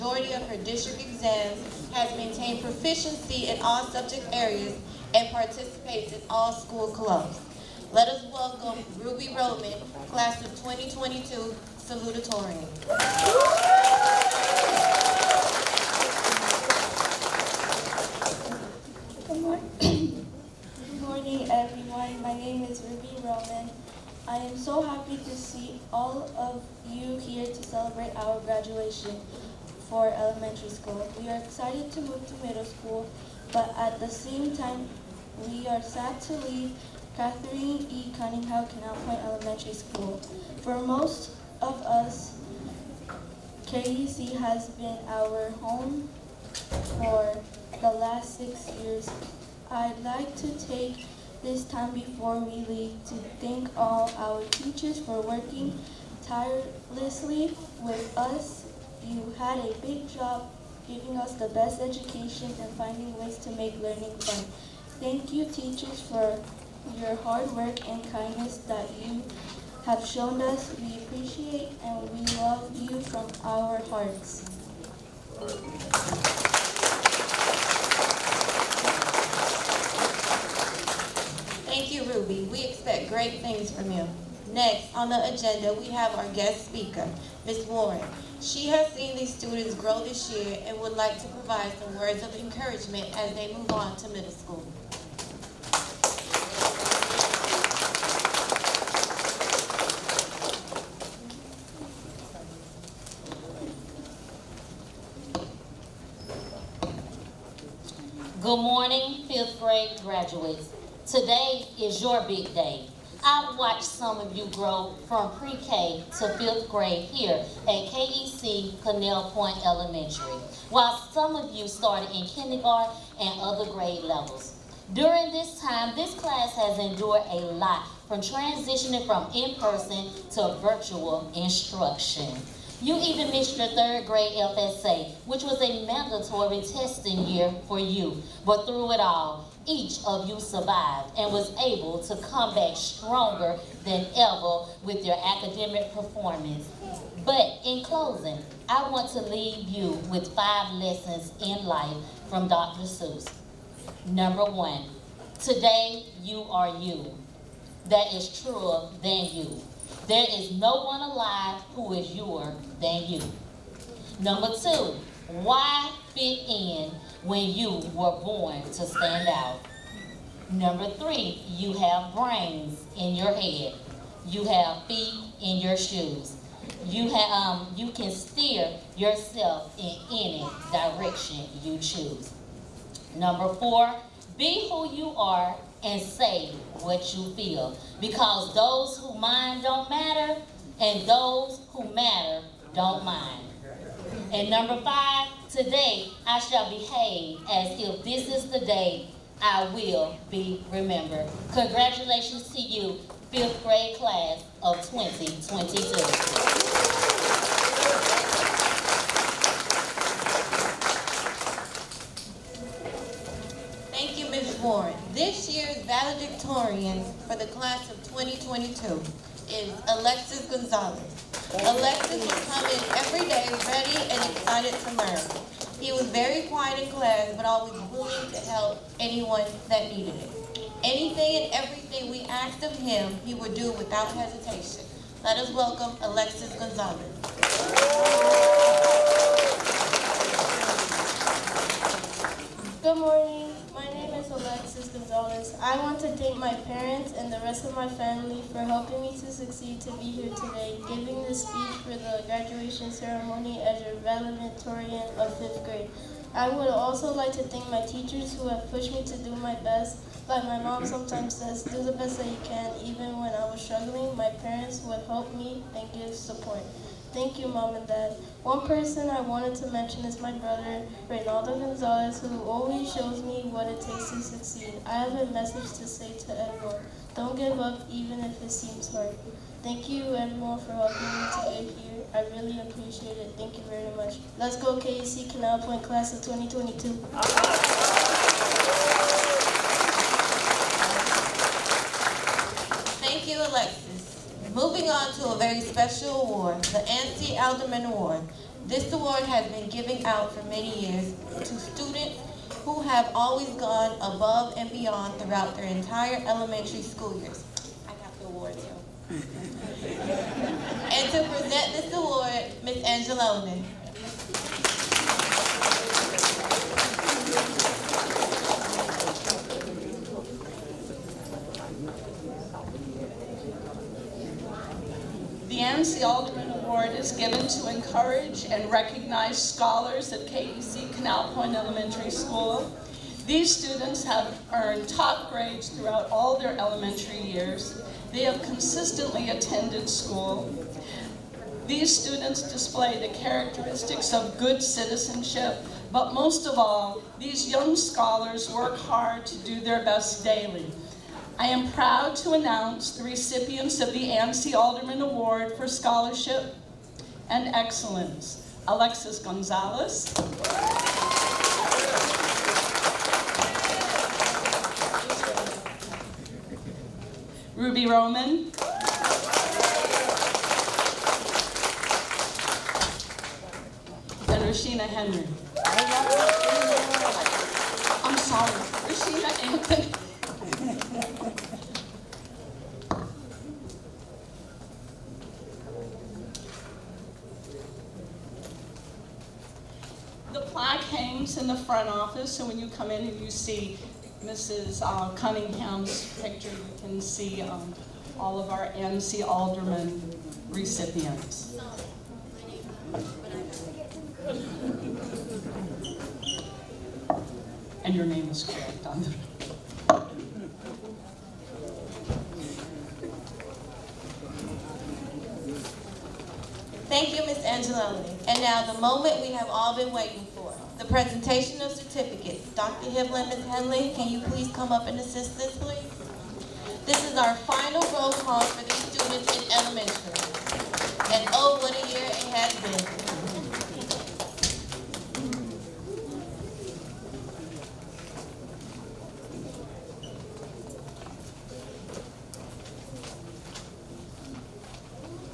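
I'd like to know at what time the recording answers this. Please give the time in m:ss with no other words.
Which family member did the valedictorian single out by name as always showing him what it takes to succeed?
4:31.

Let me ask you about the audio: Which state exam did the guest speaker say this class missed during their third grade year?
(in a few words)
FSA.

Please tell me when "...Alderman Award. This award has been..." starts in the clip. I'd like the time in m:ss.
4:57.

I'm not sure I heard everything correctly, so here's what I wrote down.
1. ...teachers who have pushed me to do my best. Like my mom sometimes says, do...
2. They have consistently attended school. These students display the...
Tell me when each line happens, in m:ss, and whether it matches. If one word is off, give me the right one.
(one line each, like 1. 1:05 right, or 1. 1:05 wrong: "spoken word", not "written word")
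1. 4:17 right
2. 5:38 right.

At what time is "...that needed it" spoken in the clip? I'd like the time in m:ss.
3:49.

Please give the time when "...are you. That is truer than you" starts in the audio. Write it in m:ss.
2:36.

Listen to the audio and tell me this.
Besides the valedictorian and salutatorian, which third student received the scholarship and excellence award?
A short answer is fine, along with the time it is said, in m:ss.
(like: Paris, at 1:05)
Rashina Henry, at 6:14.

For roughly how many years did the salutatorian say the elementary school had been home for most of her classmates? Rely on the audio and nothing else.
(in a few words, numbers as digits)
6.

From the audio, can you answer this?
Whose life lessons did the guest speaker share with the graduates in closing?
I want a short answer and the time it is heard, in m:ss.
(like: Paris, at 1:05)
Dr. Seuss, at 2:32.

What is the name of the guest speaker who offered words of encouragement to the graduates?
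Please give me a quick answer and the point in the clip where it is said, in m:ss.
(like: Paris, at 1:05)
Ms. Warren, at 1:27.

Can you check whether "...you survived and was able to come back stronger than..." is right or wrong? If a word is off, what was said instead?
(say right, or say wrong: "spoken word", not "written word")
right.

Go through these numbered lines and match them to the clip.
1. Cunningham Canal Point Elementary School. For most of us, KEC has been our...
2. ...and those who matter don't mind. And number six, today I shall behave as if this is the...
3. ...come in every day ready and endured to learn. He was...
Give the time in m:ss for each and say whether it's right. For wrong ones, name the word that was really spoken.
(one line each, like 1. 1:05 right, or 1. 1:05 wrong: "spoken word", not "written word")
1. 0:38 right
2. 3:10 wrong: "five", not "six"
3. 3:42 wrong: "excited", not "endured".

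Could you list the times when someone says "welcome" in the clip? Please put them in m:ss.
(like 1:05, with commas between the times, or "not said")
0:08, 3:55.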